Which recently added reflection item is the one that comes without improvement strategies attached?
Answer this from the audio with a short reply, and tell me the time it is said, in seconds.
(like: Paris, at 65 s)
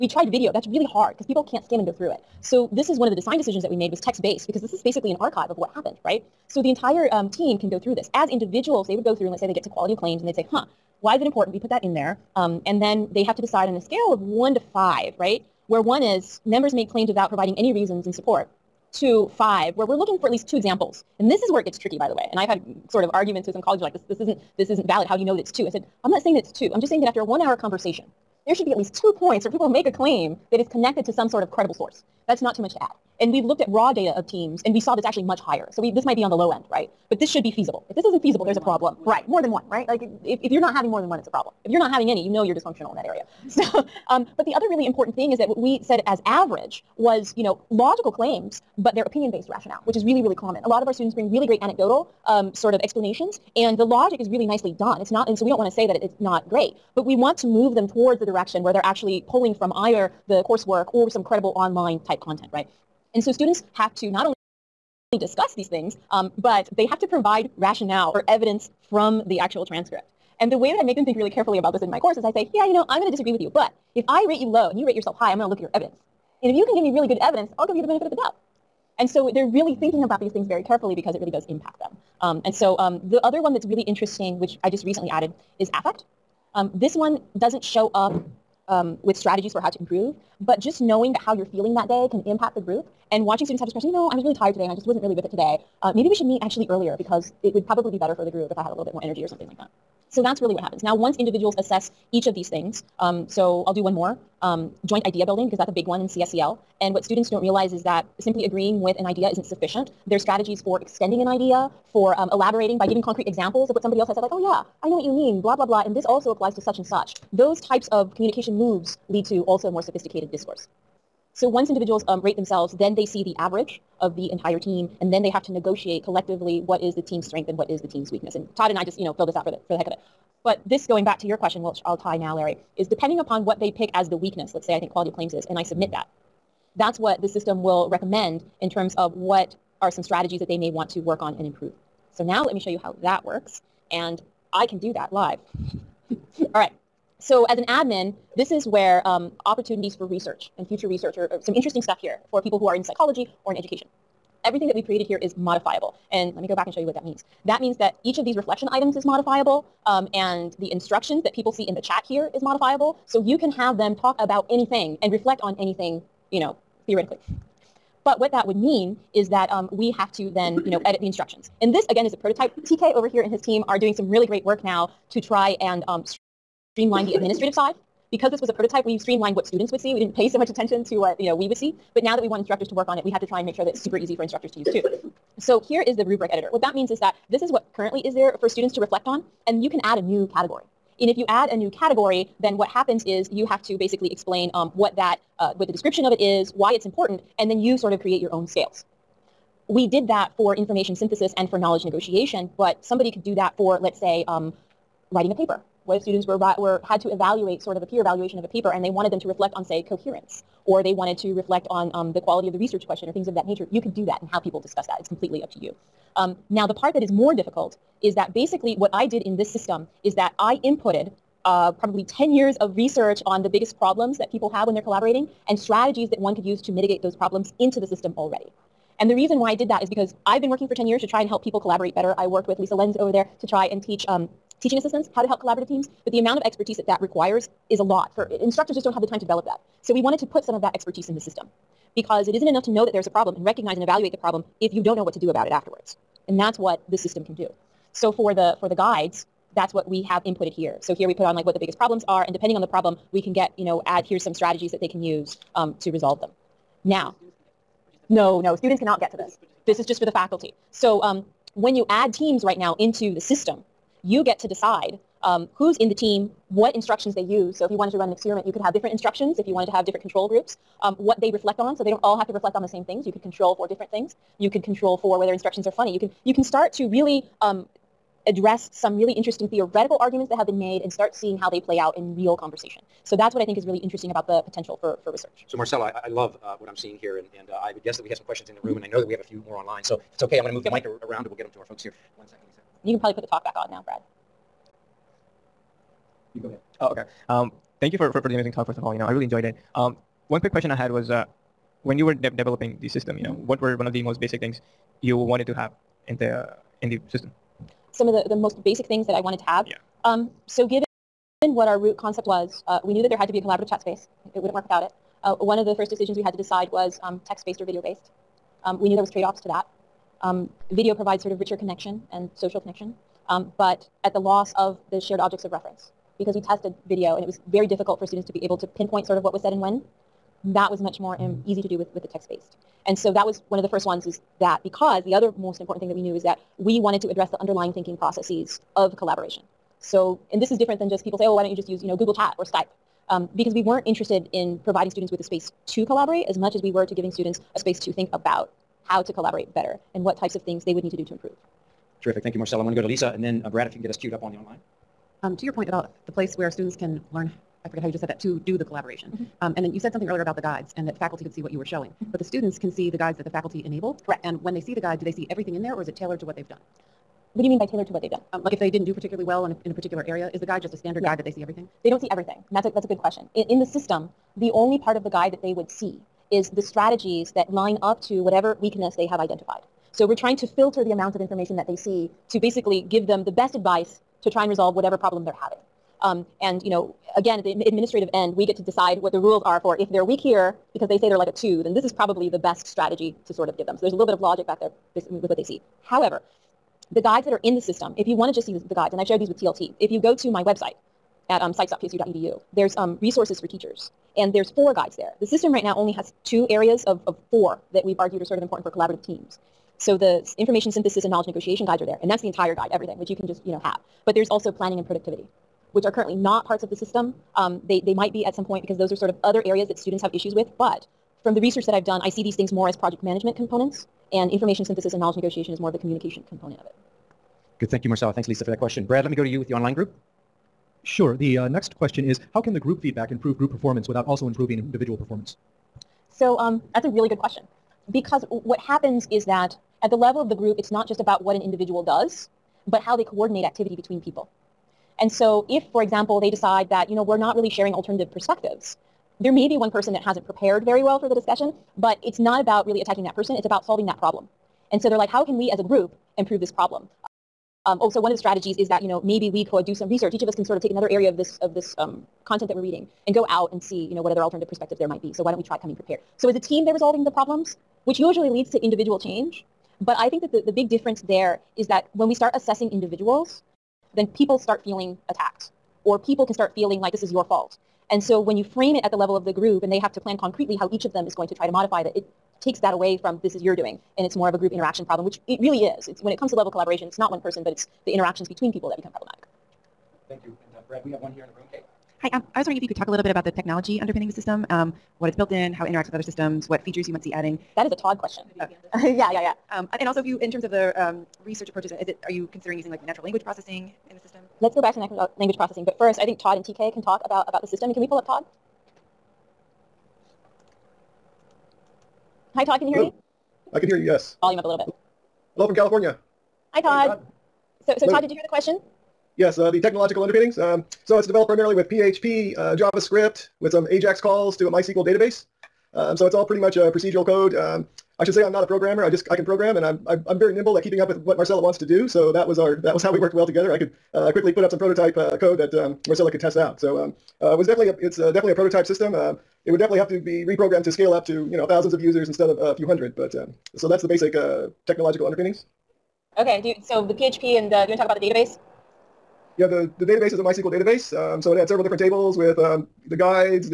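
Affect, at 85 s.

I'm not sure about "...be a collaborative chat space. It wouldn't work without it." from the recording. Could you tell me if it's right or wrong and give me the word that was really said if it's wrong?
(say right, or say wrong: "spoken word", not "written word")
right.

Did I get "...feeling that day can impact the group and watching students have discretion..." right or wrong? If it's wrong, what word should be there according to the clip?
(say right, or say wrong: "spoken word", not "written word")
right.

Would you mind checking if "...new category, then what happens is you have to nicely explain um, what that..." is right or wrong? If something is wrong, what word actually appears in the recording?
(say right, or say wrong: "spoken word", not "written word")
wrong: "basically", not "nicely".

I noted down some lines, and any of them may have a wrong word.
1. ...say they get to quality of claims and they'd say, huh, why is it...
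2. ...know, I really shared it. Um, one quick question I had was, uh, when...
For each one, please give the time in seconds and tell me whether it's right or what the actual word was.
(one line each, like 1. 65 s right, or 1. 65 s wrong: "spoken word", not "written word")
1. 9 s right
2. 298 s wrong: "enjoyed", not "shared".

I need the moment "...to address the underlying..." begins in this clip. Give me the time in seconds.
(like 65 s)
337 s.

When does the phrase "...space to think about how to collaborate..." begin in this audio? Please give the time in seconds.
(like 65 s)
347 s.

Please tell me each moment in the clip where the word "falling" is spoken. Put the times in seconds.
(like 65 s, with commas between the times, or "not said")
not said.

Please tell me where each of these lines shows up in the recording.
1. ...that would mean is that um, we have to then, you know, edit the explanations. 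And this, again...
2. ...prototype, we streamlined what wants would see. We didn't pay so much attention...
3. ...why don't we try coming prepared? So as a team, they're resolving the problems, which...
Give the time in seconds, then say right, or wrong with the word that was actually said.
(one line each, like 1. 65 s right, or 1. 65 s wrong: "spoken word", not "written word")
1. 168 s wrong: "instructions", not "explanations"
2. 178 s wrong: "students", not "wants"
3. 465 s right.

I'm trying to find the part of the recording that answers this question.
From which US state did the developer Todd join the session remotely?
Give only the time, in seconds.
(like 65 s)
515 s.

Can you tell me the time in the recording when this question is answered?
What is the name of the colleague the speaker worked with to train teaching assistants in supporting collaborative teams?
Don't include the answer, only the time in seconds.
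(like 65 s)
232 s.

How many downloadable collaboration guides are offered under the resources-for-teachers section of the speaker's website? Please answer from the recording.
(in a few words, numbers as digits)
4.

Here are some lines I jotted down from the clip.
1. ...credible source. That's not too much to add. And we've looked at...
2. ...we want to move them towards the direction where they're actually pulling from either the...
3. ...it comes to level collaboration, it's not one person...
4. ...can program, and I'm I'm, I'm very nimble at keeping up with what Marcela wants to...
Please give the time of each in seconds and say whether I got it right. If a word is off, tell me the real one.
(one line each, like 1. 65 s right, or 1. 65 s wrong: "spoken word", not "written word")
1. 31 s right
2. 57 s right
3. 486 s right
4. 529 s right.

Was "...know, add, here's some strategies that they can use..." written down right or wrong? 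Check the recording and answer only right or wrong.
right.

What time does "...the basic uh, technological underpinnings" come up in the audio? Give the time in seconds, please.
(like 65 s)
543 s.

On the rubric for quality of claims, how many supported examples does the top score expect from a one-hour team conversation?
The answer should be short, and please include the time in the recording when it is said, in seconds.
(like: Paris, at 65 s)
2, at 20 s.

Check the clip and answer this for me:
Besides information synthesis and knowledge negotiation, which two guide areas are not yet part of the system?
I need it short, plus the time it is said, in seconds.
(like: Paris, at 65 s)
Planning and productivity, at 414 s.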